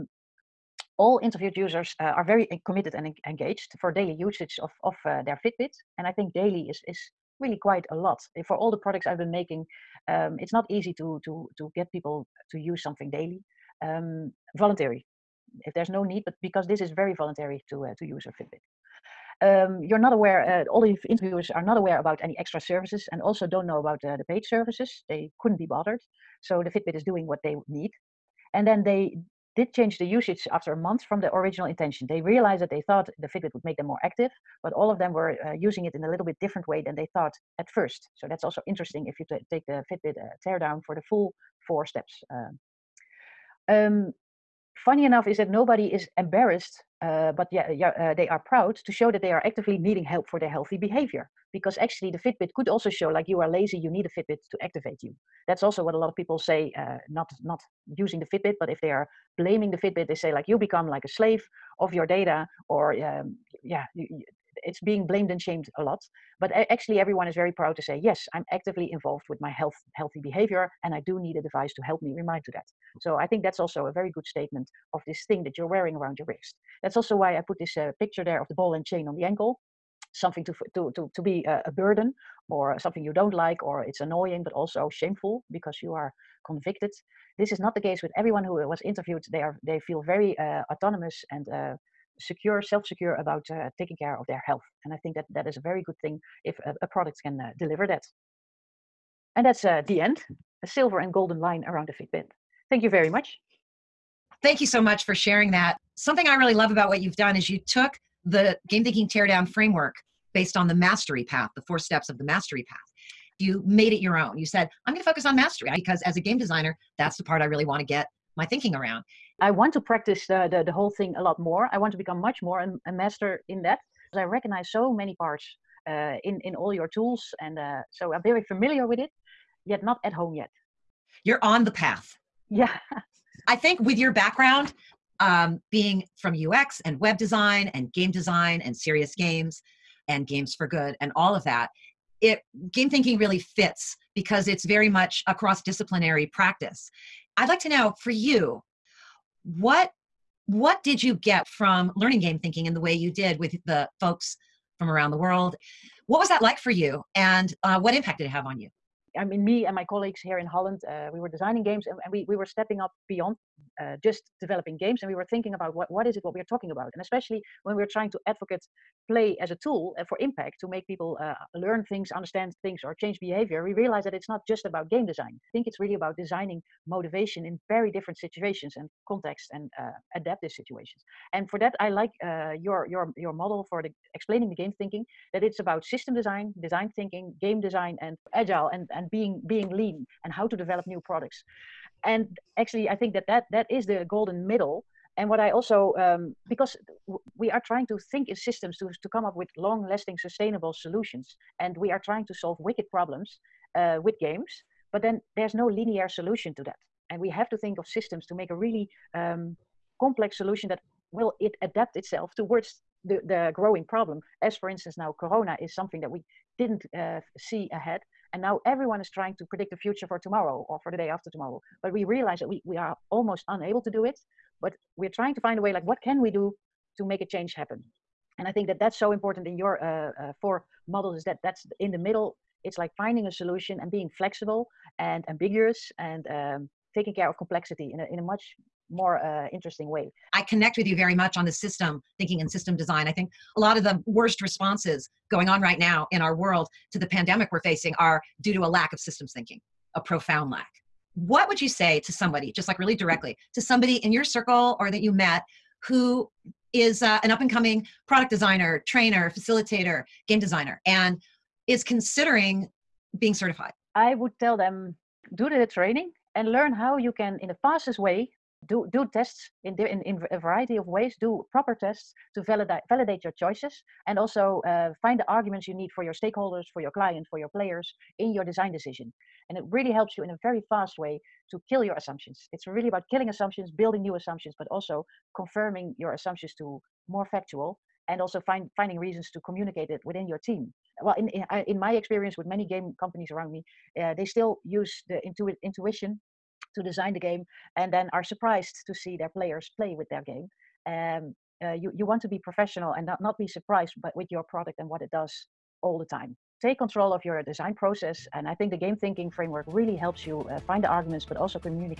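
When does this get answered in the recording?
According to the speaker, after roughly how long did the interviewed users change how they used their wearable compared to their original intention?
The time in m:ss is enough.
0:30.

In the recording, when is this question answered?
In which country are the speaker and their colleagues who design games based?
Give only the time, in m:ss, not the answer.
2:40.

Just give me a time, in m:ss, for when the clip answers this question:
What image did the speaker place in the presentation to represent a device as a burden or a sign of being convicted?
1:18.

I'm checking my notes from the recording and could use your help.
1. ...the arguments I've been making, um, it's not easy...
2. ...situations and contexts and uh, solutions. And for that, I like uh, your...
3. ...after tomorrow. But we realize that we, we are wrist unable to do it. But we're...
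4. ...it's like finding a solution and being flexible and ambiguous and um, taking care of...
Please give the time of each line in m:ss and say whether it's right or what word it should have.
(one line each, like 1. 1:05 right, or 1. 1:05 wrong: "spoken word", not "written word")
1. 0:08 wrong: "products", not "arguments"
2. 2:58 wrong: "situations", not "solutions"
3. 3:41 wrong: "almost", not "wrist"
4. 3:52 right.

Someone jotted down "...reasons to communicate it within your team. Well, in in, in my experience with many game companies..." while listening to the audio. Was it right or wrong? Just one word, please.
right.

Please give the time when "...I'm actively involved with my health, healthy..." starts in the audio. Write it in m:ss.
1:08.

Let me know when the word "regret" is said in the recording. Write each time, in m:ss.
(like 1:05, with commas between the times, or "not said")
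not said.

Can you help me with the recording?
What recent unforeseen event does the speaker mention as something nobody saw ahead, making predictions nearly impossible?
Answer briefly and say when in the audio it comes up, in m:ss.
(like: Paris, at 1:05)
Corona, at 3:35.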